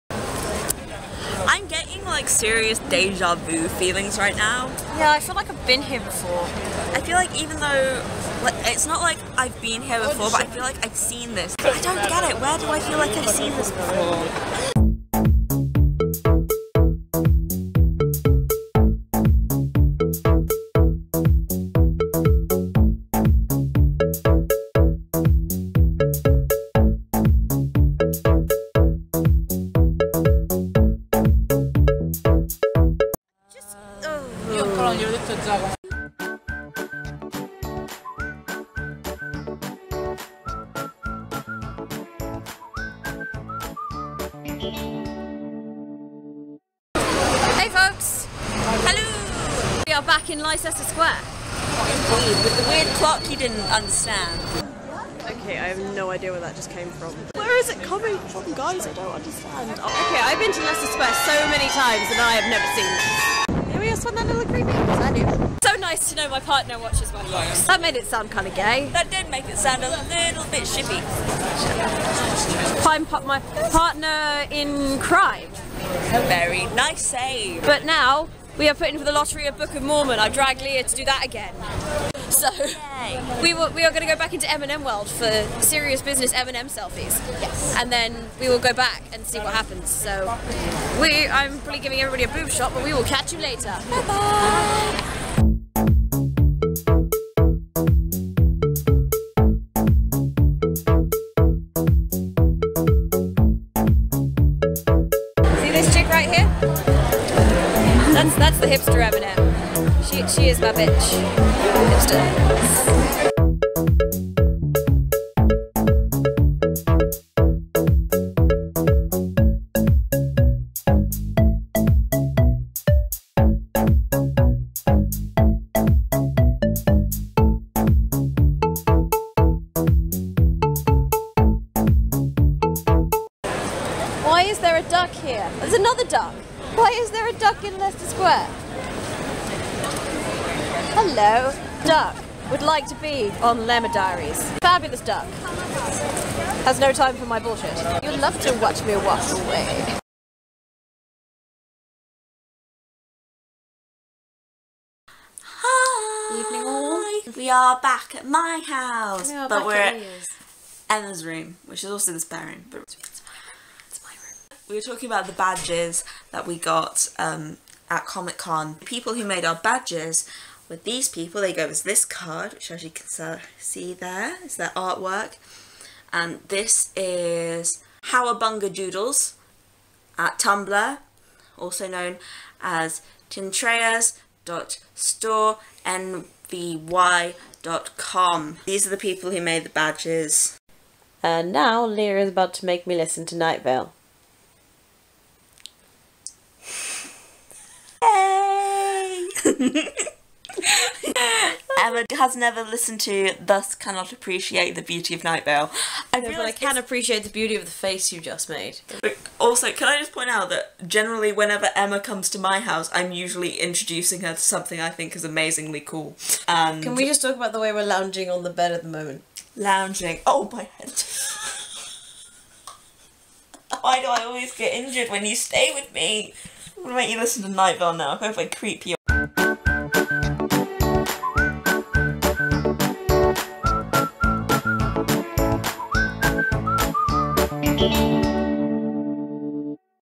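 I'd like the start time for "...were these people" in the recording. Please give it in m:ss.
2:50.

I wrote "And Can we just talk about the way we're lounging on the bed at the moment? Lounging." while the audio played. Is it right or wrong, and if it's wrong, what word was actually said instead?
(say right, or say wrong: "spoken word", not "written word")
right.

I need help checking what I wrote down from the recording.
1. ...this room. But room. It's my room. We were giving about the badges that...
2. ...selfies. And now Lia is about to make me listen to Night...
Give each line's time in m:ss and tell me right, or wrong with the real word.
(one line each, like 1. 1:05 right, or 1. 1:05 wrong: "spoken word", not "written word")
1. 2:42 wrong: "talking", not "giving"
2. 3:09 wrong: "badges", not "selfies".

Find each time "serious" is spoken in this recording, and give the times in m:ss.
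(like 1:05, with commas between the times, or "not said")
0:02, 1:25.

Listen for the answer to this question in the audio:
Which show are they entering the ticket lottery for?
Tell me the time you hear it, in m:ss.
1:19.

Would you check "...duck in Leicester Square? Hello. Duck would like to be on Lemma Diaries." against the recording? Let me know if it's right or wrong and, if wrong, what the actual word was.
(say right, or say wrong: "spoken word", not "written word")
right.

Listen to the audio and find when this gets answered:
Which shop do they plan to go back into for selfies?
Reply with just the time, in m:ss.
1:24.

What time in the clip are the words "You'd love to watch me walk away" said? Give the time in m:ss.
2:28.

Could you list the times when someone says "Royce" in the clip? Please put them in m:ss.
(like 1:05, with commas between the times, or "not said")
not said.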